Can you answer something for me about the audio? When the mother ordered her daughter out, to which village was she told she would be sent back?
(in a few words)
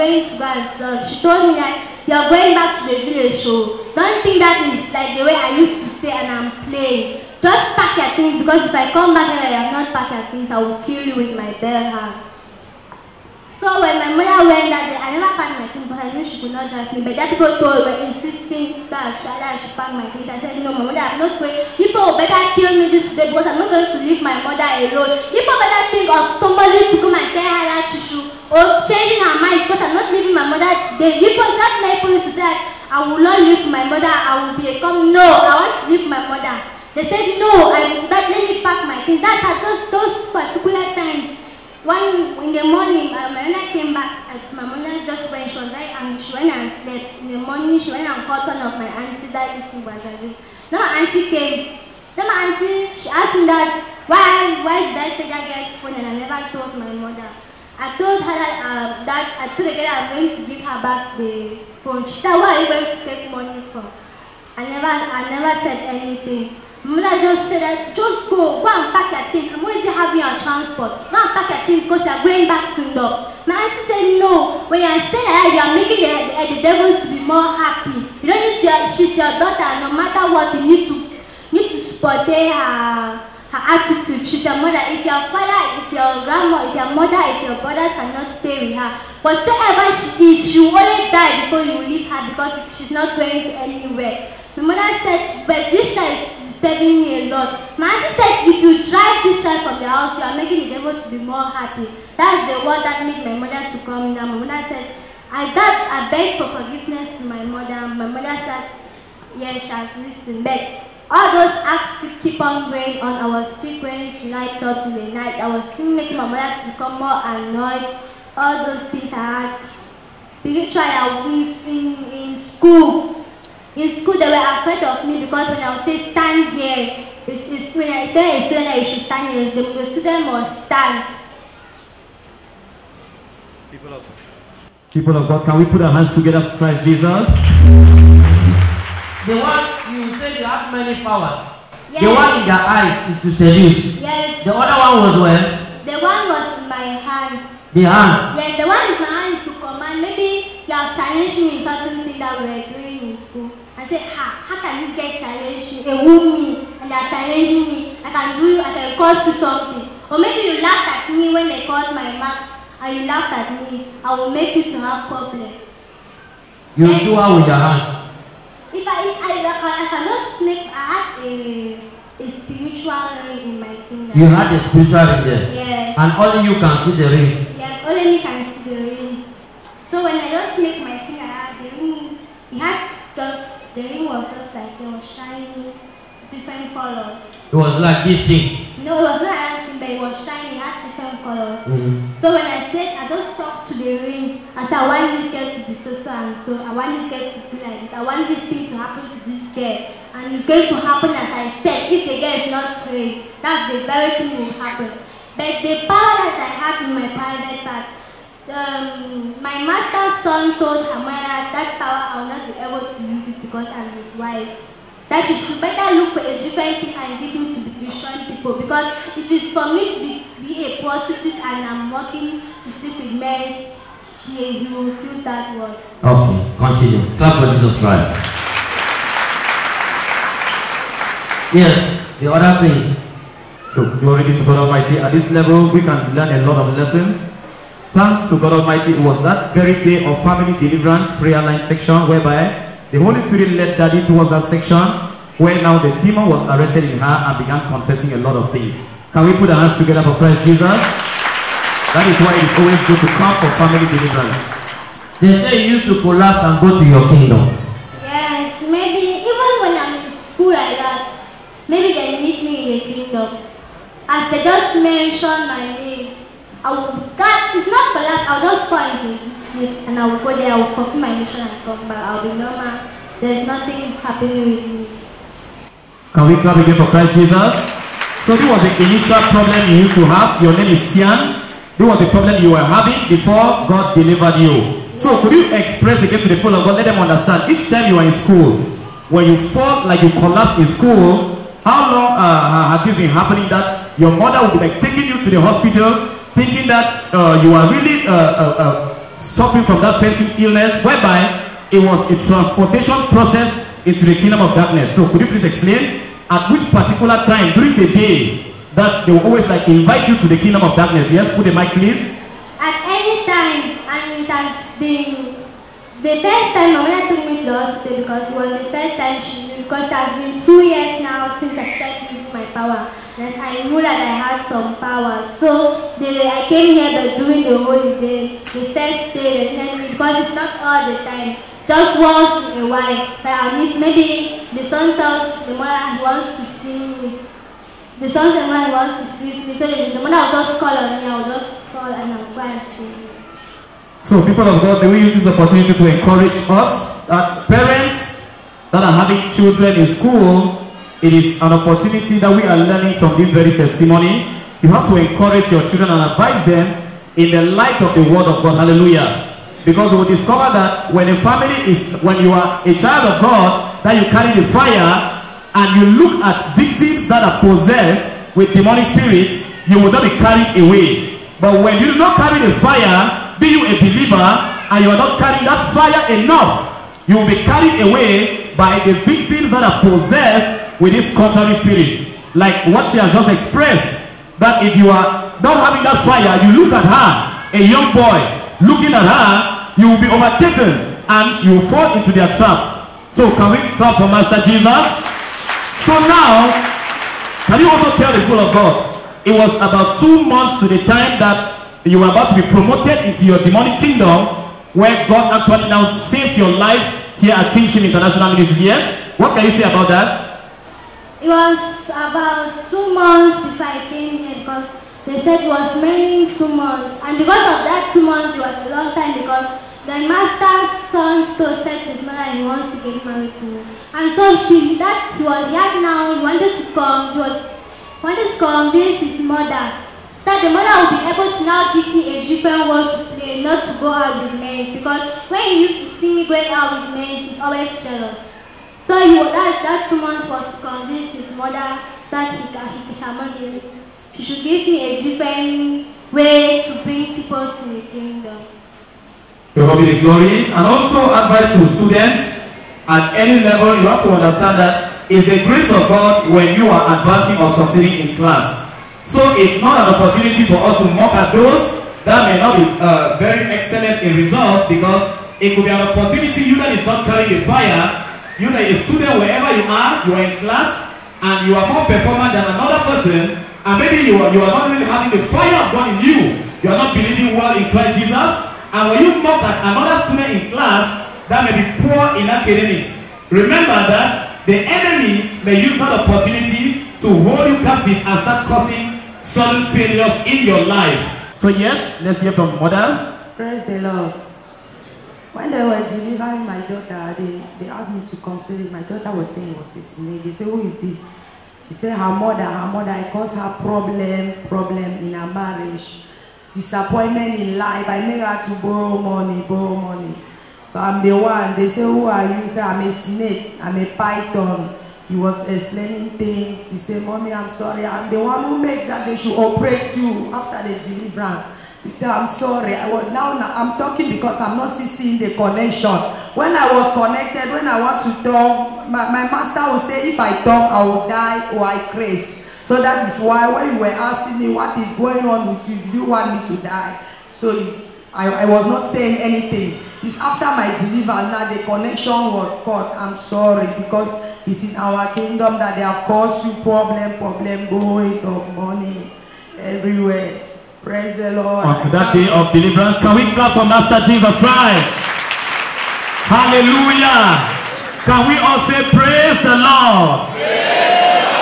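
Ndo.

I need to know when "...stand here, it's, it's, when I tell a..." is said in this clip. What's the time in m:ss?
2:06.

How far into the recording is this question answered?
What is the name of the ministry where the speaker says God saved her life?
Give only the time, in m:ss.
6:47.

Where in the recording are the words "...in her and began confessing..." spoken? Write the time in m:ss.
4:06.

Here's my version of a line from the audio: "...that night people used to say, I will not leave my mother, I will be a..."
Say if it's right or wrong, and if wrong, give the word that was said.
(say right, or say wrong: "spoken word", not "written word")
right.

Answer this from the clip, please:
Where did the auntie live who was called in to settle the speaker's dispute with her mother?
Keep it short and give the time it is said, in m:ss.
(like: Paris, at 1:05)
Guadalupe, at 0:49.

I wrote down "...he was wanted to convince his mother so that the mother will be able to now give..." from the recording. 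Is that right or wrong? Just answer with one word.
right.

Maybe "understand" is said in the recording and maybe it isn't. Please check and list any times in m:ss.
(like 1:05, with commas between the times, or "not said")
4:47, 7:34.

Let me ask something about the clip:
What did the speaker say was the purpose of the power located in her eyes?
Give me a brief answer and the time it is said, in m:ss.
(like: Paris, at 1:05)
to seduce, at 2:23.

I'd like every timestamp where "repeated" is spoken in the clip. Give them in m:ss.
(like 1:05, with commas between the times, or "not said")
not said.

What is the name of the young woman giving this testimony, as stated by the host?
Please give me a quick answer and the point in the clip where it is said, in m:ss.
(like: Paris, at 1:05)
Sian, at 4:40.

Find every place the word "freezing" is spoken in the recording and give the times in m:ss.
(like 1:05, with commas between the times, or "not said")
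not said.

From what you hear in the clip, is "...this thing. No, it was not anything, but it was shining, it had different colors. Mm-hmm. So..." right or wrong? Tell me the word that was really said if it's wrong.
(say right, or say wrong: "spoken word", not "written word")
right.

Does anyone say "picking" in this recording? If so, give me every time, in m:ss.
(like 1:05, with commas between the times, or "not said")
not said.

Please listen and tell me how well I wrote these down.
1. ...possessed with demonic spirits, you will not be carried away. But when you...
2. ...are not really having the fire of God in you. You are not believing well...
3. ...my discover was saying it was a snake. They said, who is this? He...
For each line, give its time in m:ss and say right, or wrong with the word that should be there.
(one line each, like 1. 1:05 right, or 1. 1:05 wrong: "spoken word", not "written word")
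1. 6:07 right
2. 7:54 right
3. 8:18 wrong: "daughter", not "discover".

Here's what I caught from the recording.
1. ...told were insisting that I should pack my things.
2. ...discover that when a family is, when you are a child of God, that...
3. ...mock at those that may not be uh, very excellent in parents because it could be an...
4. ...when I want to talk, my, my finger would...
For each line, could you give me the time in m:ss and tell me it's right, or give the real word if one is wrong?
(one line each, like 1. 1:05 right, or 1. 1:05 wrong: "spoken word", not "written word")
1. 0:17 right
2. 6:00 right
3. 7:40 wrong: "results", not "parents"
4. 8:47 wrong: "master", not "finger".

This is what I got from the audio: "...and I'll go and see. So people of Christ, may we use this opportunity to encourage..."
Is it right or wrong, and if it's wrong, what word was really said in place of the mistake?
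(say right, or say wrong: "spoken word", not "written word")
wrong: "God", not "Christ".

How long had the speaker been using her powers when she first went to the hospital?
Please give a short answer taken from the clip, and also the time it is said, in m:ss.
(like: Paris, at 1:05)
two years, at 5:20.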